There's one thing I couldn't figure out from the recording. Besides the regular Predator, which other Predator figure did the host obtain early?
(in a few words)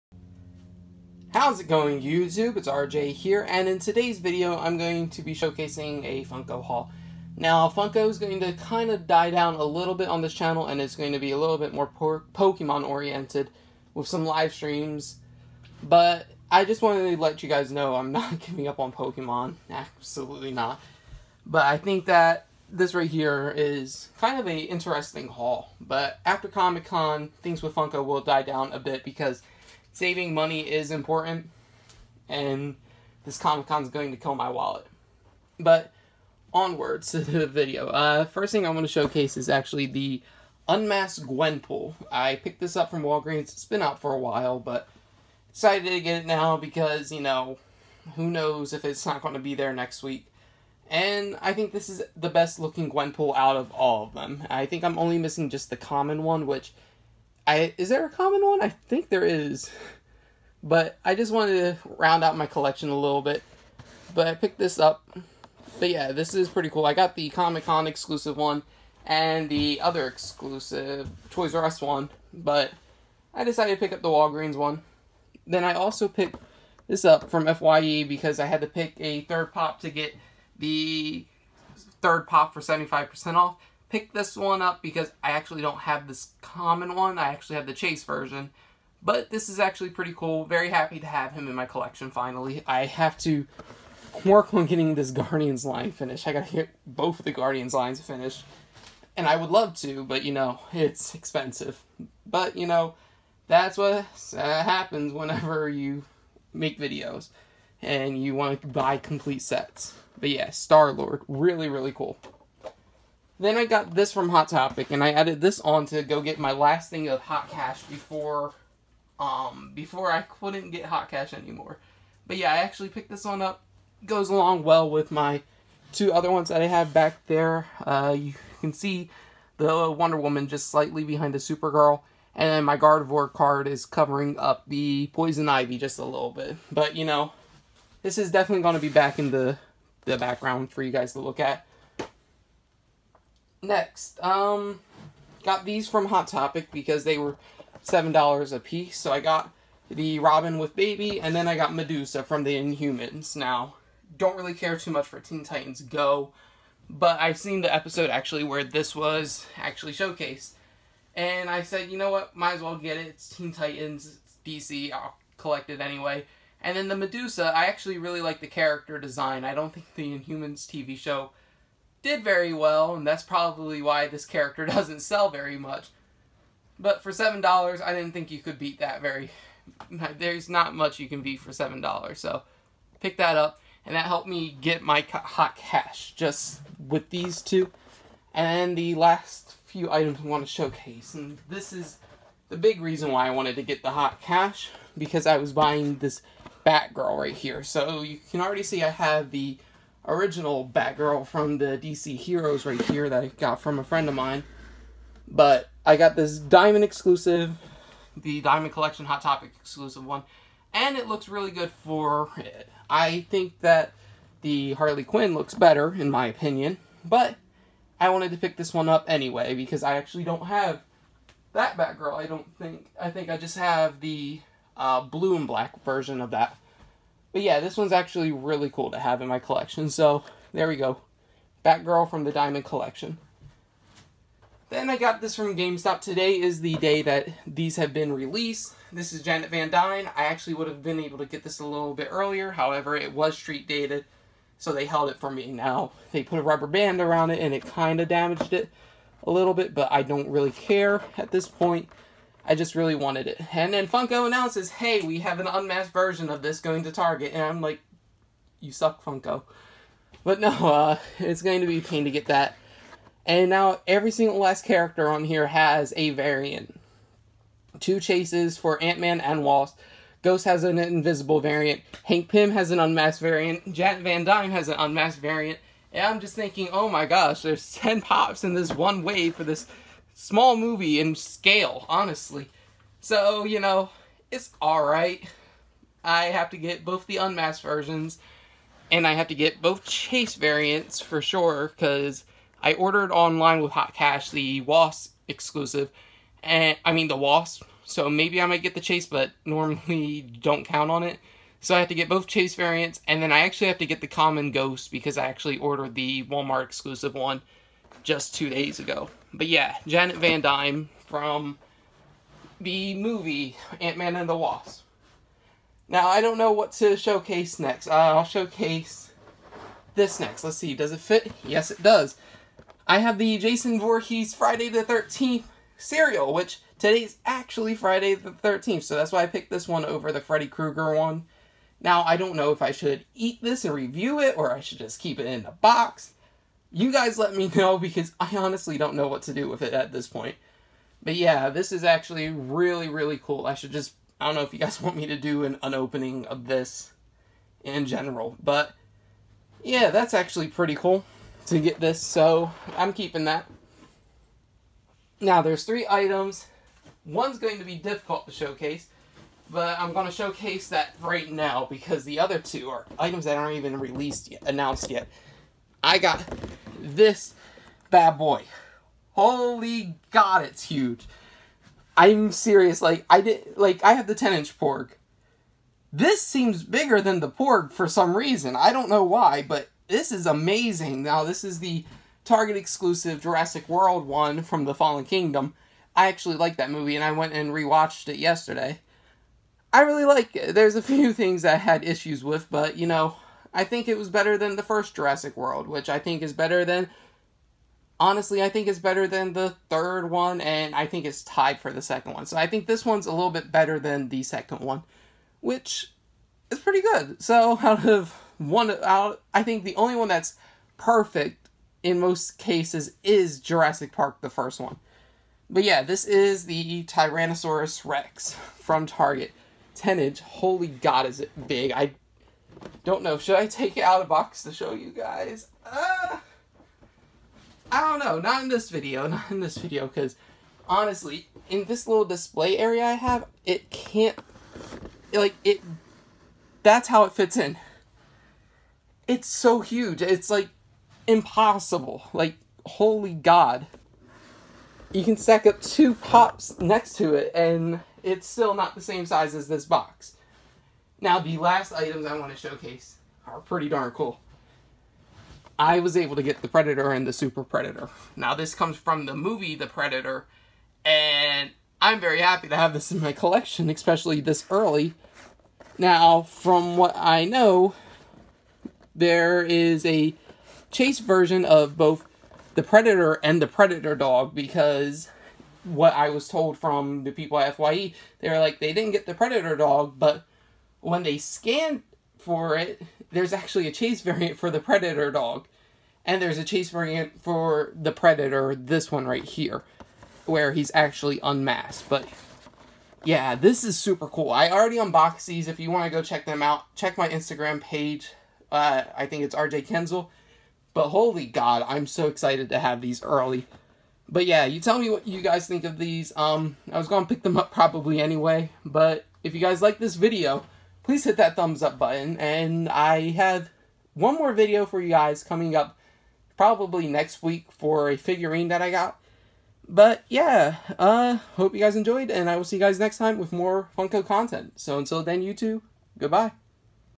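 Super Predator.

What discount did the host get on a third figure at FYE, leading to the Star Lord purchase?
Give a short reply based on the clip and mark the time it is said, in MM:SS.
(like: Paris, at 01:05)
75%, at 01:22.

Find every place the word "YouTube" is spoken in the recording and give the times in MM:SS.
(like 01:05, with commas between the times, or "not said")
00:02, 08:45.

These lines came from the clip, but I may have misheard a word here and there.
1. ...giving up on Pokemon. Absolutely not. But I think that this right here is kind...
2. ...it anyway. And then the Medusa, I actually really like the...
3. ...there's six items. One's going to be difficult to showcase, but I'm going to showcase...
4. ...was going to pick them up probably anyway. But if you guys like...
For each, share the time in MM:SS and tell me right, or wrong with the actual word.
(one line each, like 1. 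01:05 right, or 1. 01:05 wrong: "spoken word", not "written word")
1. 00:18 right
2. 02:45 right
3. 05:55 wrong: "three", not "six"
4. 08:26 right.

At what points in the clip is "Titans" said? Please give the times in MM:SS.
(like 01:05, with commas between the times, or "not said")
02:35, 02:43.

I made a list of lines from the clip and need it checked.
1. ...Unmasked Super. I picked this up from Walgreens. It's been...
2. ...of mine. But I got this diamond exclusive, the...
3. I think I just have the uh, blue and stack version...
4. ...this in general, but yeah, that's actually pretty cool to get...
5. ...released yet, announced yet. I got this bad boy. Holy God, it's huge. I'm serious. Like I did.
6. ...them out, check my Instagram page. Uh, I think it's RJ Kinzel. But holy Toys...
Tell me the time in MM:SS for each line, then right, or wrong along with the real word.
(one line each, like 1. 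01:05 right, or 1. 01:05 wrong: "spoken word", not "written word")
1. 00:40 wrong: "Gwenpool", not "Super"
2. 03:24 right
3. 03:42 wrong: "black", not "stack"
4. 05:46 right
5. 06:03 right
6. 08:16 wrong: "God", not "Toys".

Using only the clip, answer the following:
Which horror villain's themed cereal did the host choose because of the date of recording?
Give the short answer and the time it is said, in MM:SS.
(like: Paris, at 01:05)
Jason Voorhees, at 05:23.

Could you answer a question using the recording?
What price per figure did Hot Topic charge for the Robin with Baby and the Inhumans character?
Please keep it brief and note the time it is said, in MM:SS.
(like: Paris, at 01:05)
$7, at 02:27.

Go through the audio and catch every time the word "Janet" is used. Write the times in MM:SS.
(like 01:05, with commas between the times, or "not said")
03:59, 05:09.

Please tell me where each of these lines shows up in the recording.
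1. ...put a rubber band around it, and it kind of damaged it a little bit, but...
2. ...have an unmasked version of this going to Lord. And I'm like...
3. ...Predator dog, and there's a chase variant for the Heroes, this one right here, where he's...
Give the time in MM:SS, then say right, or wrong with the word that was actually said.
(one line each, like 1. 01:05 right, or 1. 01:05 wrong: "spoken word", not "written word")
1. 04:06 right
2. 04:15 wrong: "Target", not "Lord"
3. 08:04 wrong: "Predator", not "Heroes".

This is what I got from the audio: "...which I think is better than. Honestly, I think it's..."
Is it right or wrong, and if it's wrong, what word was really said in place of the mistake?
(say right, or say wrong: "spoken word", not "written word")
right.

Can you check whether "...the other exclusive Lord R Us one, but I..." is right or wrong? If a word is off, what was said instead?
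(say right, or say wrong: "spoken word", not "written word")
wrong: "Toys", not "Lord".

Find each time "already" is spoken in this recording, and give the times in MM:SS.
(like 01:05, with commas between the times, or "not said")
03:18, 08:14.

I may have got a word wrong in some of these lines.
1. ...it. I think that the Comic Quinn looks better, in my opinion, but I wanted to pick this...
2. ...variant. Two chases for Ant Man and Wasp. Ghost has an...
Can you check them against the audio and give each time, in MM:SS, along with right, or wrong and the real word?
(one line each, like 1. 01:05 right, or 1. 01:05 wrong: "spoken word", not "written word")
1. 03:32 wrong: "Harley", not "Comic"
2. 04:26 right.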